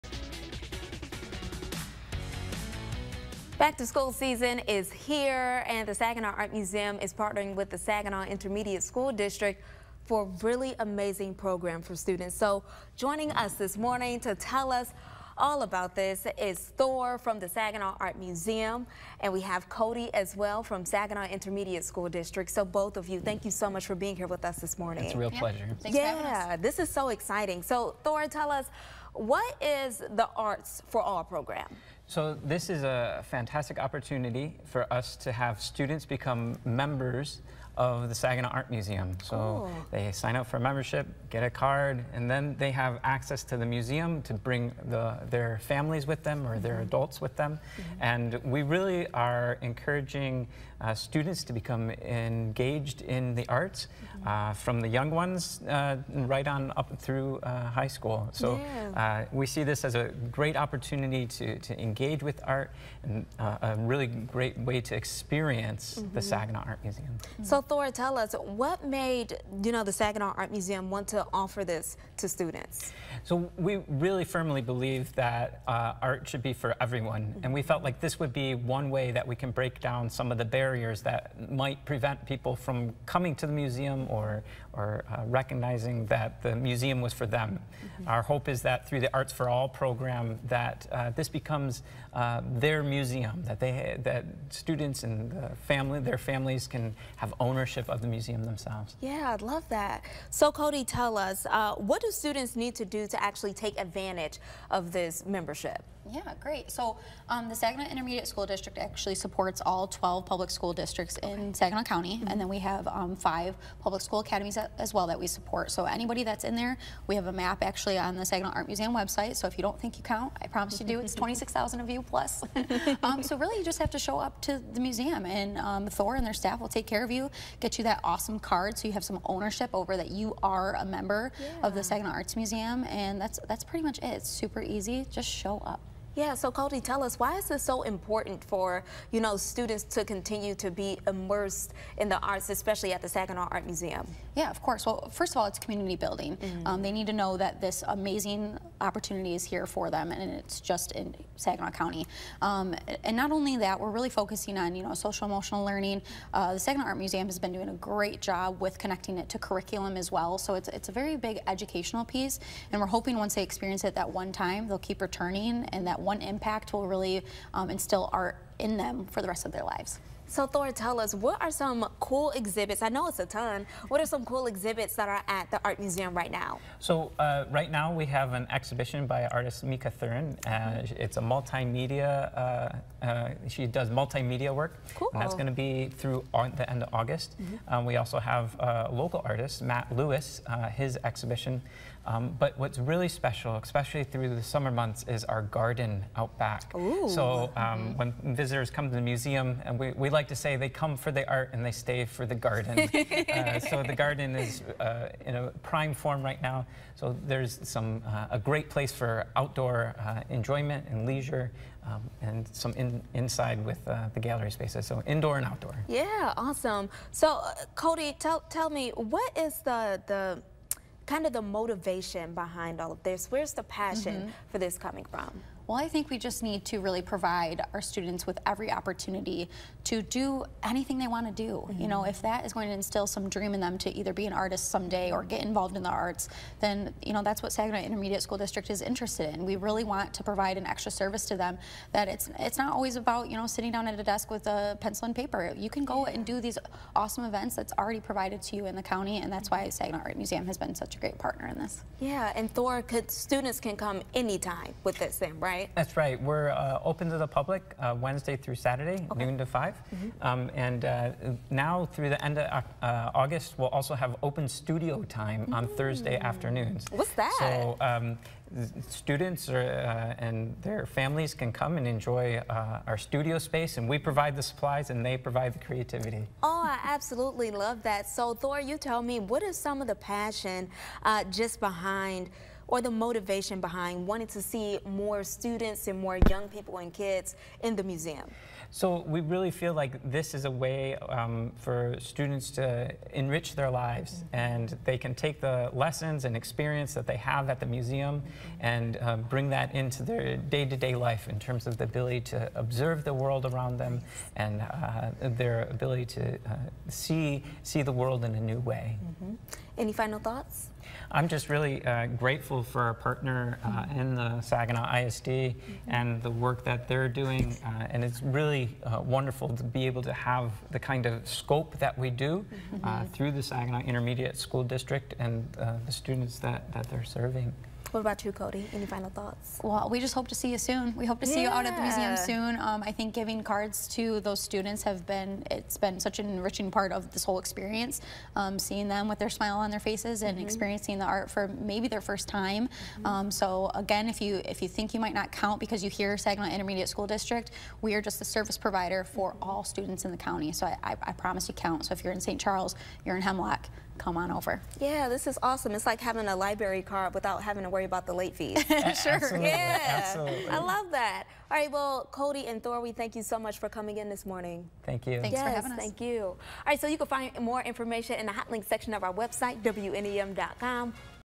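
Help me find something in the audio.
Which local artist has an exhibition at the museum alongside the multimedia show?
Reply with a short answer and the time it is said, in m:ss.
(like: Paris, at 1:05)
Matt Lewis, at 3:09.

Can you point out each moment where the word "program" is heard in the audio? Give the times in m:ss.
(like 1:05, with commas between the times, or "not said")
0:11, 0:31, 1:29.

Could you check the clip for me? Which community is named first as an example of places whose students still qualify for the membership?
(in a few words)
St. Charles.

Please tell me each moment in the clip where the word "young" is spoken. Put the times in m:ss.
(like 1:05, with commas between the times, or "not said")
0:54, 4:46.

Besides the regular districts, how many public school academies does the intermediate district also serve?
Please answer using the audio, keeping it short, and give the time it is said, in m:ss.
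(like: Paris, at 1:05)
5, at 1:53.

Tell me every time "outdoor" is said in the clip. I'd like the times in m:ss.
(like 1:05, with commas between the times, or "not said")
3:29, 3:35.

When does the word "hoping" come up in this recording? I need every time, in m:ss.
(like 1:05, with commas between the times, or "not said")
2:42.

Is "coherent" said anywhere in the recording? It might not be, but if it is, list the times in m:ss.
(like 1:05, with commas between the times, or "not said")
not said.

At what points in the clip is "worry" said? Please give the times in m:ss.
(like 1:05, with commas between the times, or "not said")
5:57.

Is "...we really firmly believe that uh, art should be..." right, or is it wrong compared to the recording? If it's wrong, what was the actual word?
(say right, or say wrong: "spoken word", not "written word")
right.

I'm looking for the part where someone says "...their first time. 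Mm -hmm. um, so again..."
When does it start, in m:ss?
5:41.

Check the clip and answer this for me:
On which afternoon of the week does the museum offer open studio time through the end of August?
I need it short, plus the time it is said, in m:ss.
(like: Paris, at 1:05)
Thursday, at 4:25.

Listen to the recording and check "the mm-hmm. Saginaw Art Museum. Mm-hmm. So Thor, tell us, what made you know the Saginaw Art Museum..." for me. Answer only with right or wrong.
right.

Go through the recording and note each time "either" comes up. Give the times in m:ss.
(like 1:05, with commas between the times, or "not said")
3:53.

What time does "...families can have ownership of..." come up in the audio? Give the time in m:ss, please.
1:36.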